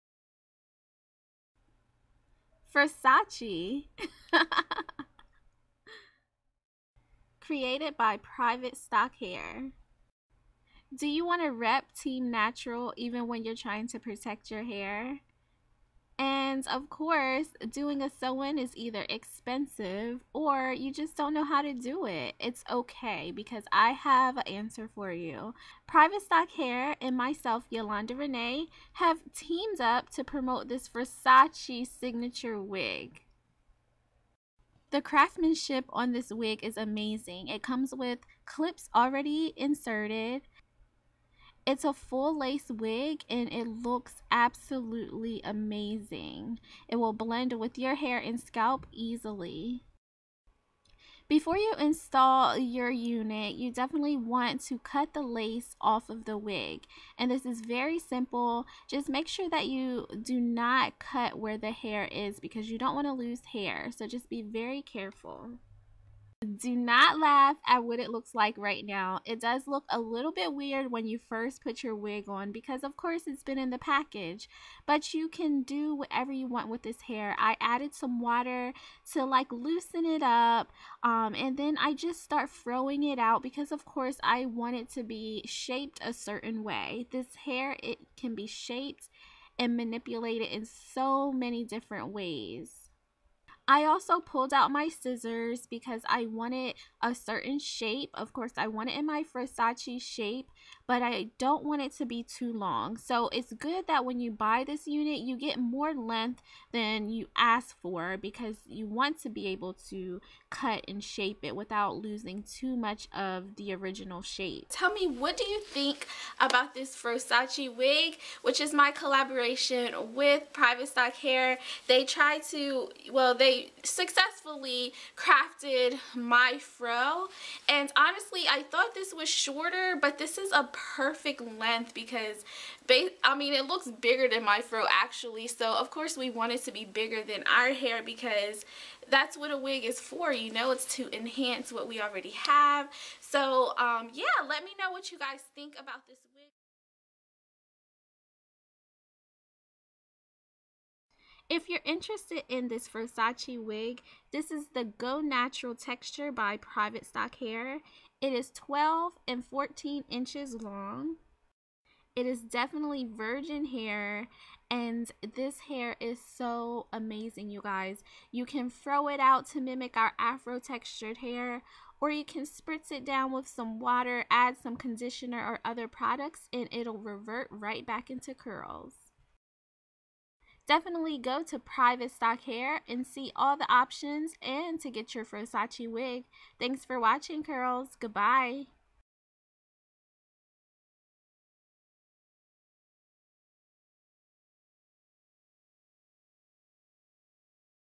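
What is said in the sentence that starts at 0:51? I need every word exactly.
Before you install your unit, you definitely want to cut the lace off of the wig.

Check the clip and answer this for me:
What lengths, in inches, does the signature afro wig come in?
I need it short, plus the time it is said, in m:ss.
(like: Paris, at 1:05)
12 and 14 inches, at 2:38.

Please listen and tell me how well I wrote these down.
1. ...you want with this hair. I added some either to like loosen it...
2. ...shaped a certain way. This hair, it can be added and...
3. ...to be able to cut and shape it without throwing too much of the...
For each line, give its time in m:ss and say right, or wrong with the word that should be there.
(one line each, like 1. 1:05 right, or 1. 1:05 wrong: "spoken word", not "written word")
1. 1:16 wrong: "water", not "either"
2. 1:25 wrong: "shaped", not "added"
3. 1:49 wrong: "losing", not "throwing".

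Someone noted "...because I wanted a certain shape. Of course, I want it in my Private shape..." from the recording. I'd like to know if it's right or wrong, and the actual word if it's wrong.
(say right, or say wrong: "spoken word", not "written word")
wrong: "Frosace", not "Private".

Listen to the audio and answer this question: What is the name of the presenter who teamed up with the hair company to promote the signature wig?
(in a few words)
Yolanda Renee.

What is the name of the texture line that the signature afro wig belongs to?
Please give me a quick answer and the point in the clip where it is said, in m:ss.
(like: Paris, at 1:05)
Go Natural Texture, at 2:34.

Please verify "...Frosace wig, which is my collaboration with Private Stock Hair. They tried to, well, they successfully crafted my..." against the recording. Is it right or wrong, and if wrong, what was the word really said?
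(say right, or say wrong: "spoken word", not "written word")
right.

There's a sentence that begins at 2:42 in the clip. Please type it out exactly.
It is definitely virgin hair and this hair is so amazing, you guys.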